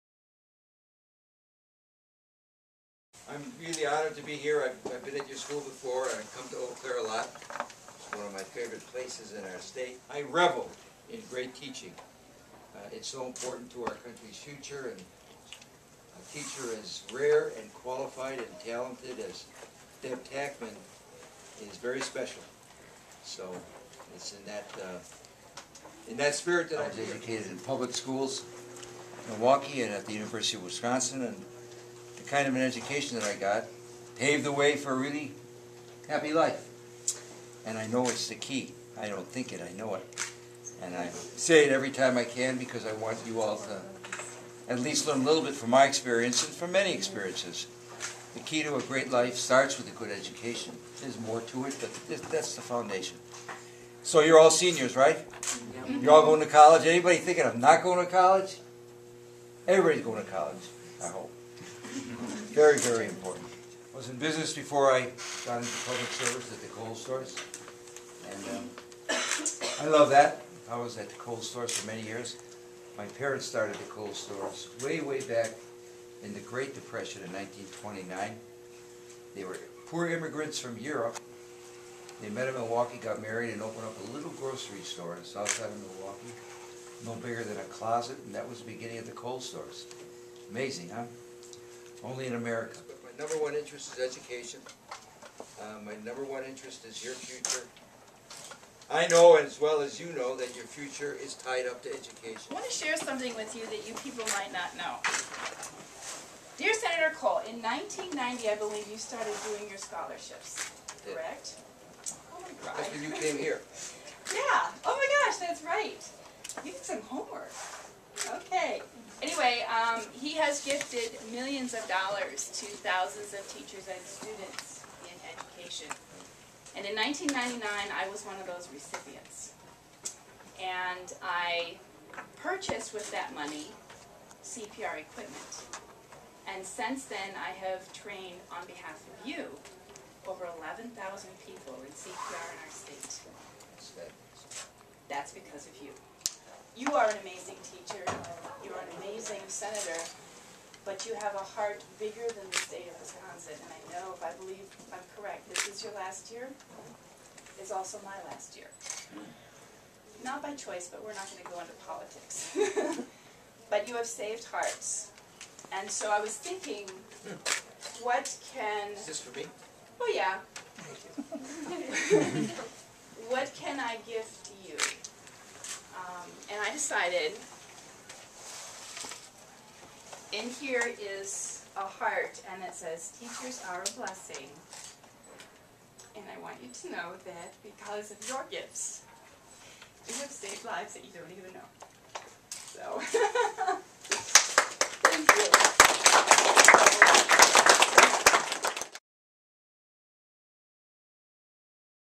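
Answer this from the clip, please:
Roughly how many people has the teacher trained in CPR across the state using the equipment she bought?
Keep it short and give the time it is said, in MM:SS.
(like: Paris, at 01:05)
over 11,000, at 02:20.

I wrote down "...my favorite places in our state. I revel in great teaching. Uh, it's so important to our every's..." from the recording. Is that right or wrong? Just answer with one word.
wrong.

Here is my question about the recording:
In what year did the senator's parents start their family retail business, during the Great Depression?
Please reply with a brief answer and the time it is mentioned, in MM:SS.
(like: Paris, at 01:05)
1929, at 01:17.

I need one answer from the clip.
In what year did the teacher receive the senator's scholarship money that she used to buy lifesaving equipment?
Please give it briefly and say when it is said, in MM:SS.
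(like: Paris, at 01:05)
1999, at 02:06.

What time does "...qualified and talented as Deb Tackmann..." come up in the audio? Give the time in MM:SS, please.
00:17.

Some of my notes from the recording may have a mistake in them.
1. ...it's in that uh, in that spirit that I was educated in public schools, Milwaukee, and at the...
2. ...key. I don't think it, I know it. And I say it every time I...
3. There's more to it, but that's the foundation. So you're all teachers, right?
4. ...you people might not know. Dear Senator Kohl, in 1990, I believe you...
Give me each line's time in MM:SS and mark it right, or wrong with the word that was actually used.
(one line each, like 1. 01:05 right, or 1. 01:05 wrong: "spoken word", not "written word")
1. 00:24 right
2. 00:38 right
3. 00:51 wrong: "seniors", not "teachers"
4. 01:43 right.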